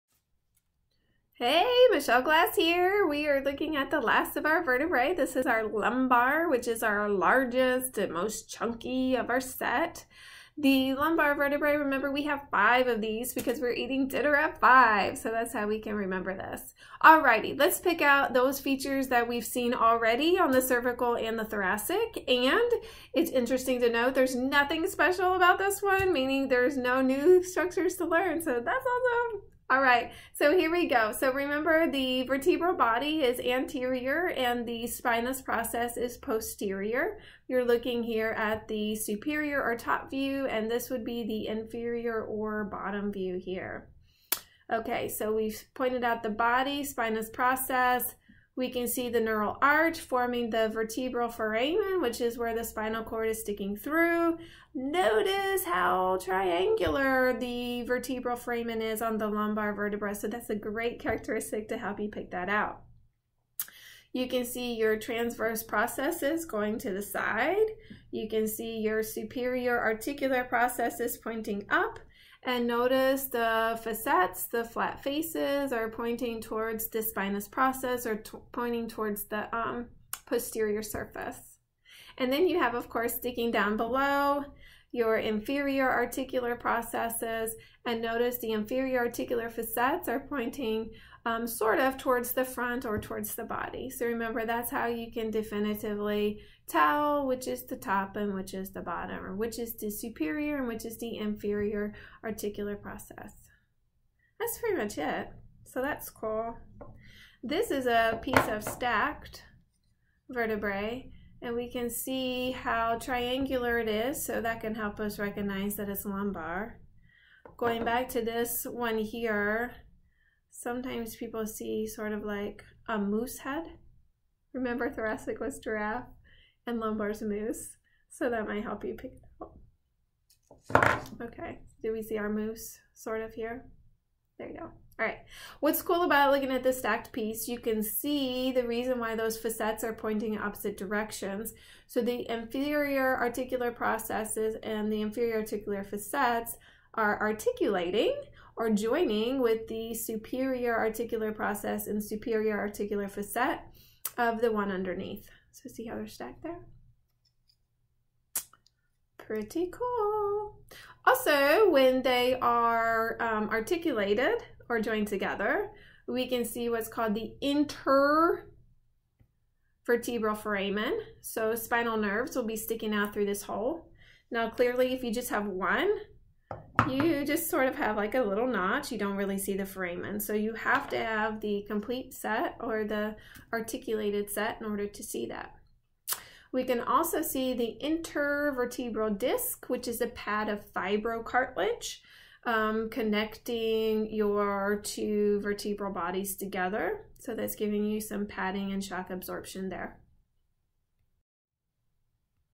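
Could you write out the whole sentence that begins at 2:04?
Remember, thoracic was giraffe and lumbar's moose, so that might help you pick it out.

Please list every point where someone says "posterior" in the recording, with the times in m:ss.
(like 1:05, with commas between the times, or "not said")
0:36, 1:20.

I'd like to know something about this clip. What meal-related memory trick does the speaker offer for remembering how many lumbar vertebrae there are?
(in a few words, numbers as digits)
eating dinner at five.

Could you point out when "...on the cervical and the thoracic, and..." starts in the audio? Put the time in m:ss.
0:20.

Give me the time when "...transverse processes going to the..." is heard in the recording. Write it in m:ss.
1:04.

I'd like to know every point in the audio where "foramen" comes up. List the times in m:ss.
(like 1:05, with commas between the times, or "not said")
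0:51, 0:58, 2:50, 2:59.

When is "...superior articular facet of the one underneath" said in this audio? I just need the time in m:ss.
2:32.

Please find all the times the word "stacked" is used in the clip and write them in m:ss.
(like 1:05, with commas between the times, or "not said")
1:48, 2:16, 2:36.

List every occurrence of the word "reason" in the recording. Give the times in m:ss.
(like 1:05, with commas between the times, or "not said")
2:18.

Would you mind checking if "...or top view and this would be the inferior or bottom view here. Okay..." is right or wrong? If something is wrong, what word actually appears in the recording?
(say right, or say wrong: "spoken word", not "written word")
right.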